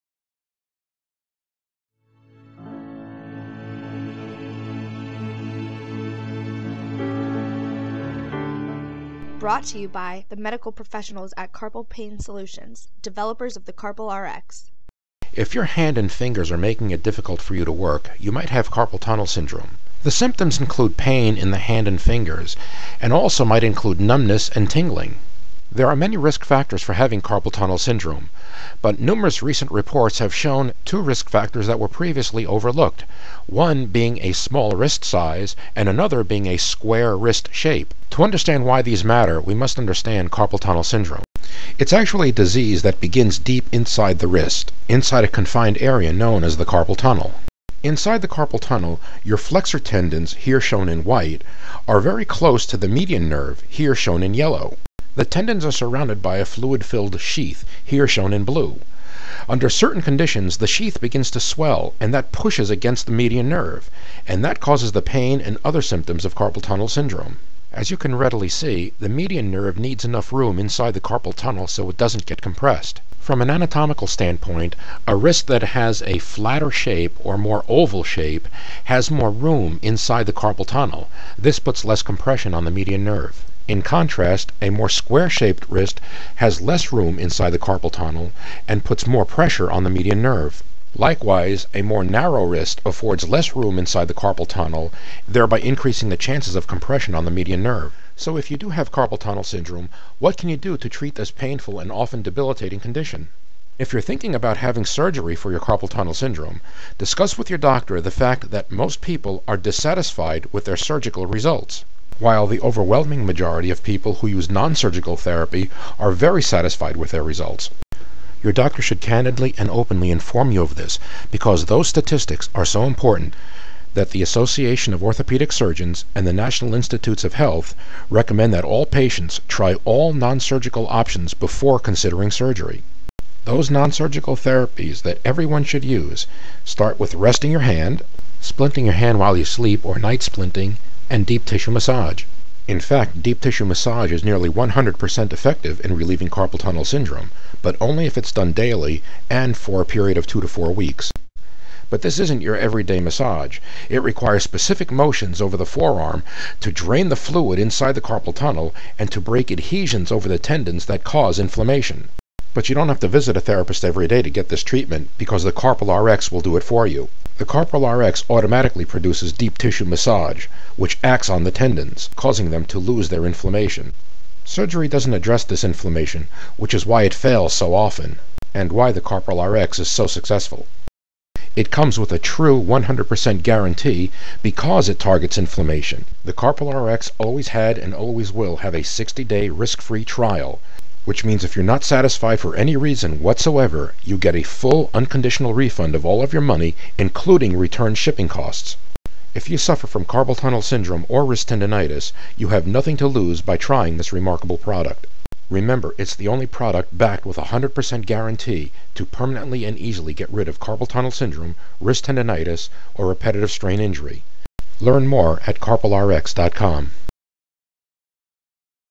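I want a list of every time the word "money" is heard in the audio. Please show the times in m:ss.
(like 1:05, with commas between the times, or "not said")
3:16.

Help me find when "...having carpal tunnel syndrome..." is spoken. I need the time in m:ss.
0:26.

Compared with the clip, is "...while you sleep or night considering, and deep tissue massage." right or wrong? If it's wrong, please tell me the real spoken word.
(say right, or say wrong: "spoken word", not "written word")
wrong: "splinting", not "considering".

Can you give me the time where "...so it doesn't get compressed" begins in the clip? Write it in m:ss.
1:11.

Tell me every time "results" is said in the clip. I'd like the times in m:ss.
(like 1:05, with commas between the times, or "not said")
1:51, 1:57.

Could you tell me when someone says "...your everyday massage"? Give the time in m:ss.
2:32.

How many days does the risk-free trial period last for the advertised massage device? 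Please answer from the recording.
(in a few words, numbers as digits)
60 days.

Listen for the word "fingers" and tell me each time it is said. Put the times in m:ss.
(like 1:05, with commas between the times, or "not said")
0:16, 0:21.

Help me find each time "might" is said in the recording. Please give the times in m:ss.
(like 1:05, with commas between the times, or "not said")
0:18, 0:23.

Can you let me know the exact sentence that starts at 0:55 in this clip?
The tendons are surrounded by a fluid-filled sheath, here shown in blue.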